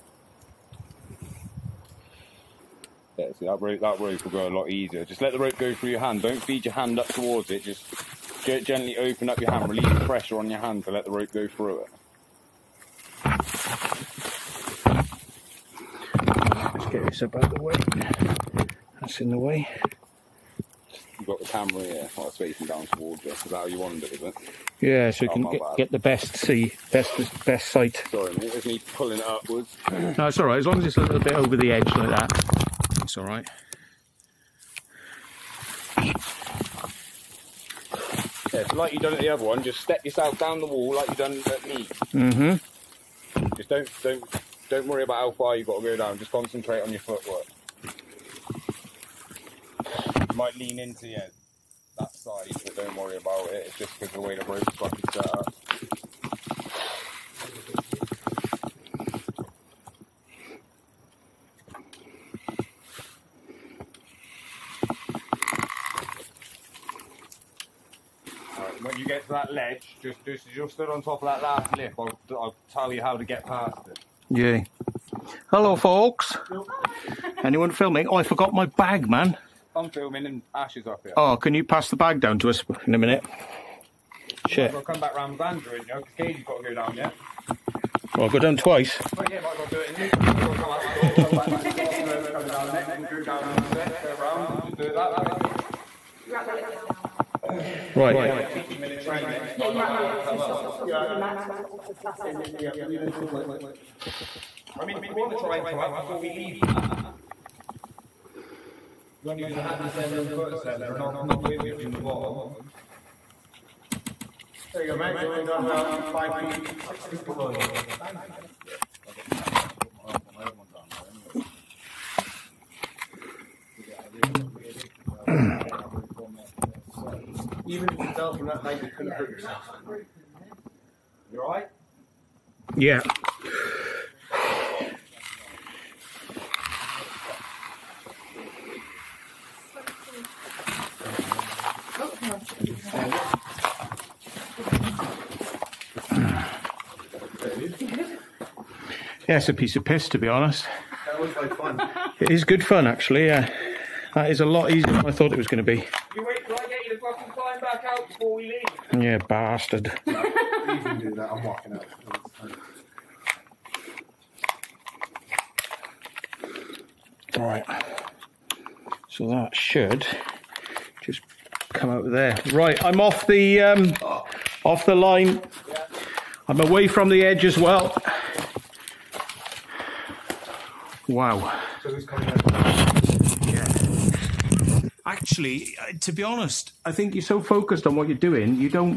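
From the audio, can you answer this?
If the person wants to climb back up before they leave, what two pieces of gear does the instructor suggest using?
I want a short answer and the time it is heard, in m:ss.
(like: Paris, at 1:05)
hand ascender and foot ascender, at 1:49.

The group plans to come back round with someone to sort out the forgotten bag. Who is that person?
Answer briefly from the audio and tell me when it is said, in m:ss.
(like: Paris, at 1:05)
Andrew, at 1:25.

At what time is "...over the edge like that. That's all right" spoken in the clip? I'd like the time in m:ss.
0:31.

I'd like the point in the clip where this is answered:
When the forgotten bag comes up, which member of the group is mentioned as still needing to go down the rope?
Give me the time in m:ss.
1:26.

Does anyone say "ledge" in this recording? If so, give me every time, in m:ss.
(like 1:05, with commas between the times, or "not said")
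1:09.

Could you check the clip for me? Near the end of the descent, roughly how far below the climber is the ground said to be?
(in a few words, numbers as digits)
5 to 6 feet.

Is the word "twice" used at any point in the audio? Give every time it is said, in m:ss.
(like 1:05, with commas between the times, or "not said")
1:28.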